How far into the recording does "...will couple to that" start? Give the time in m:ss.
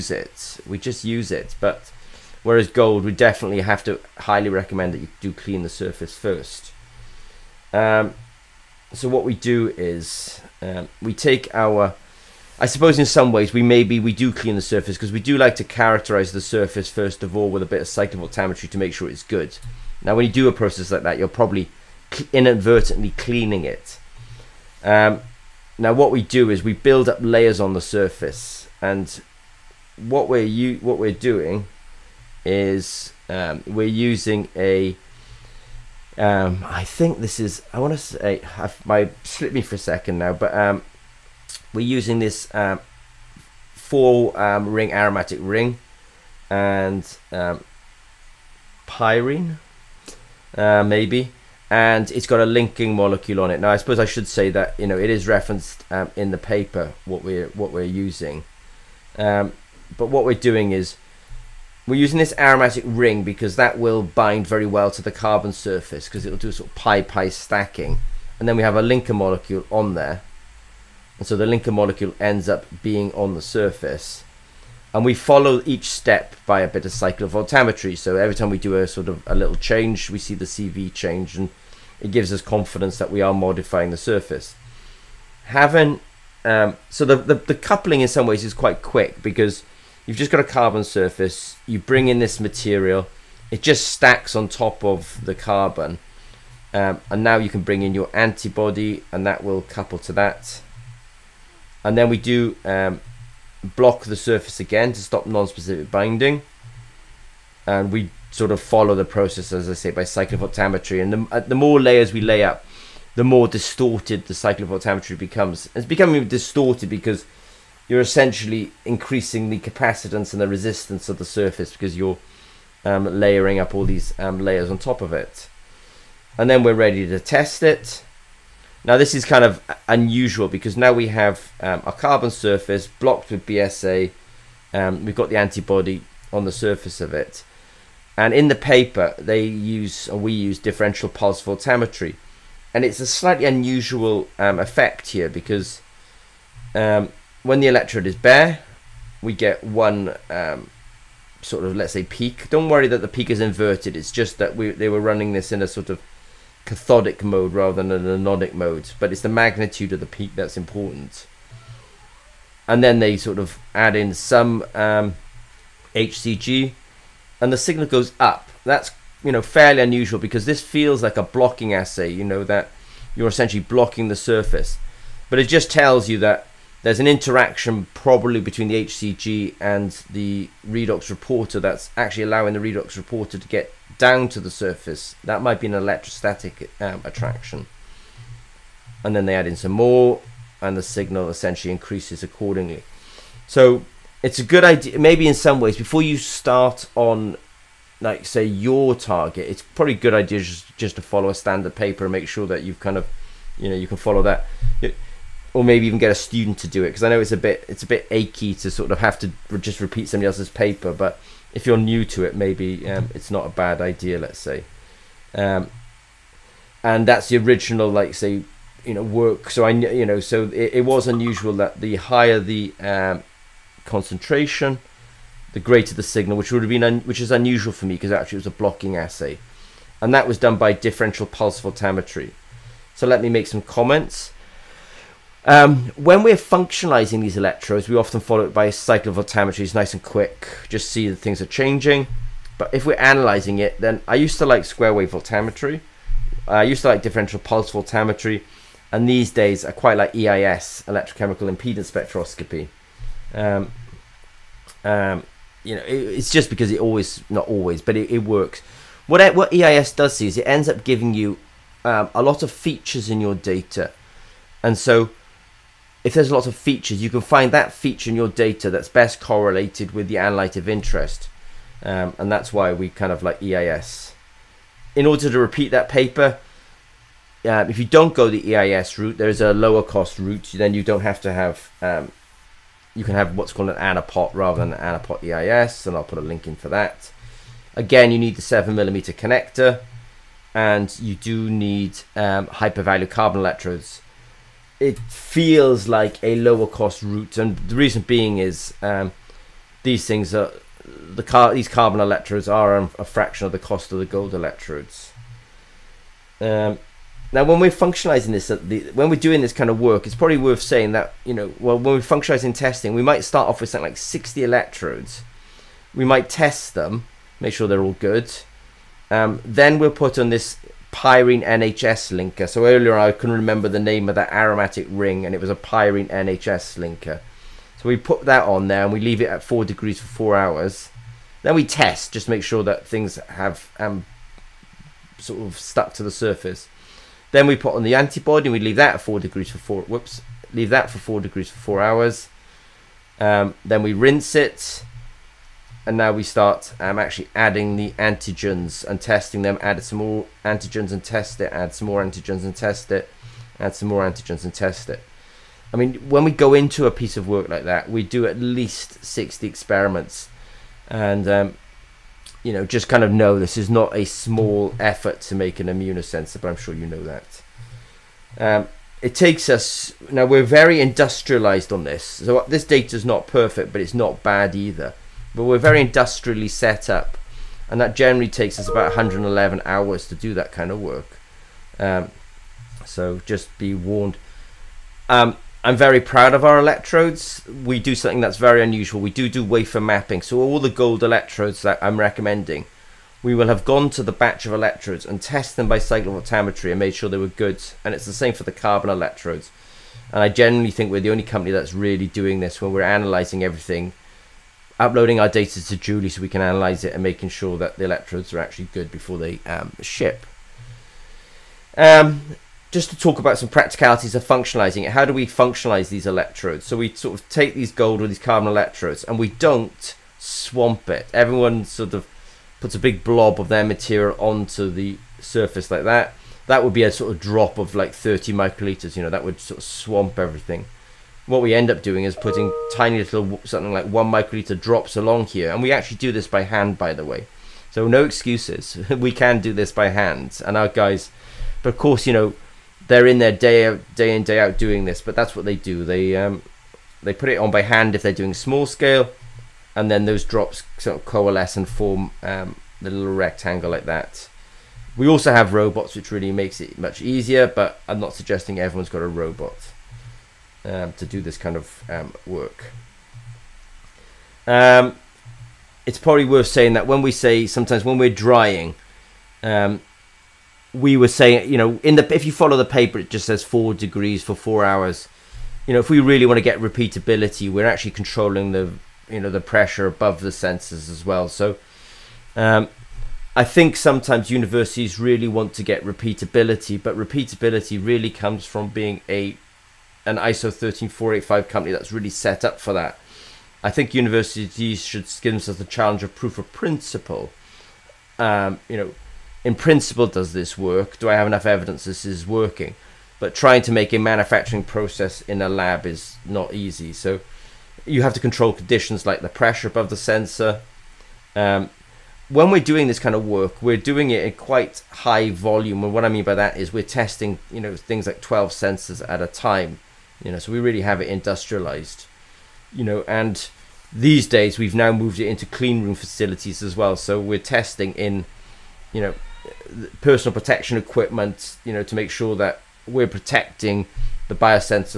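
1:39.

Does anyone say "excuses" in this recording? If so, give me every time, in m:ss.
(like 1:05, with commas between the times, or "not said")
7:18.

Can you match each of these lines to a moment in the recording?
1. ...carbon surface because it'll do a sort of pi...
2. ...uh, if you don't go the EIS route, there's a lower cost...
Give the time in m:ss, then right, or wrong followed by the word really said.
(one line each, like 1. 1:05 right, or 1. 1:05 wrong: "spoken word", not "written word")
1. 1:05 right
2. 4:37 right.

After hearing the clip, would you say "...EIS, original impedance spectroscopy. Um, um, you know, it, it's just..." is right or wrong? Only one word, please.
wrong.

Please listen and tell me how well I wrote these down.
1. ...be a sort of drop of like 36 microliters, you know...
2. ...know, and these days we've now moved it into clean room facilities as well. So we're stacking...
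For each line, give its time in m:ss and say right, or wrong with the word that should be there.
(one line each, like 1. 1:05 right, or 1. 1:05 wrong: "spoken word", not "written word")
1. 7:06 wrong: "30", not "36"
2. 8:42 wrong: "testing", not "stacking".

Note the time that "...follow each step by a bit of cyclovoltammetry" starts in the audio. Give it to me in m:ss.
1:15.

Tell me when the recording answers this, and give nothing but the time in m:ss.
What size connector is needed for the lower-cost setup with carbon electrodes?
4:48.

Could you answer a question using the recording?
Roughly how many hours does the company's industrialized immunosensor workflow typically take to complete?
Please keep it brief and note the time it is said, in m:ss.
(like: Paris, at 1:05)
111 hours, at 6:18.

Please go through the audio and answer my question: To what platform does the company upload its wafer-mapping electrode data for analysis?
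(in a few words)
DJULI.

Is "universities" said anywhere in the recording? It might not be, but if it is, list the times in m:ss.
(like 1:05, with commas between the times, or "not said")
8:04, 8:13.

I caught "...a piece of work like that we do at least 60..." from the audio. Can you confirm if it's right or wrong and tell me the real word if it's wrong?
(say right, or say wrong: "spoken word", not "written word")
right.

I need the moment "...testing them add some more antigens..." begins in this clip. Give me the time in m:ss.
5:49.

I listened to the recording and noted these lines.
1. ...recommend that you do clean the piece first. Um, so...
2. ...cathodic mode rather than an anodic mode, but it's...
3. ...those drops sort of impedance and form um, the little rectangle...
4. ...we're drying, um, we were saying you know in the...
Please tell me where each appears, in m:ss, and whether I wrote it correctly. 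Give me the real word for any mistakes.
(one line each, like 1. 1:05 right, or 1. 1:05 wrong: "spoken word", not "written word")
1. 0:04 wrong: "surface", not "piece"
2. 2:36 right
3. 7:30 wrong: "coalesce", not "impedance"
4. 7:47 right.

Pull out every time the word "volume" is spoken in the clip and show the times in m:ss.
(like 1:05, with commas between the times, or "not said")
8:35.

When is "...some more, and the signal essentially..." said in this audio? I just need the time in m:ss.
3:09.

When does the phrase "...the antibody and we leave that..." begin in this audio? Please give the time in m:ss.
5:37.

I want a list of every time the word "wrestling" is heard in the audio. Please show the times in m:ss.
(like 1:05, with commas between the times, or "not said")
not said.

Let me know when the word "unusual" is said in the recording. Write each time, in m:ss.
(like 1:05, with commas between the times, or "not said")
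2:09, 2:23, 2:49, 3:41, 3:47, 6:28.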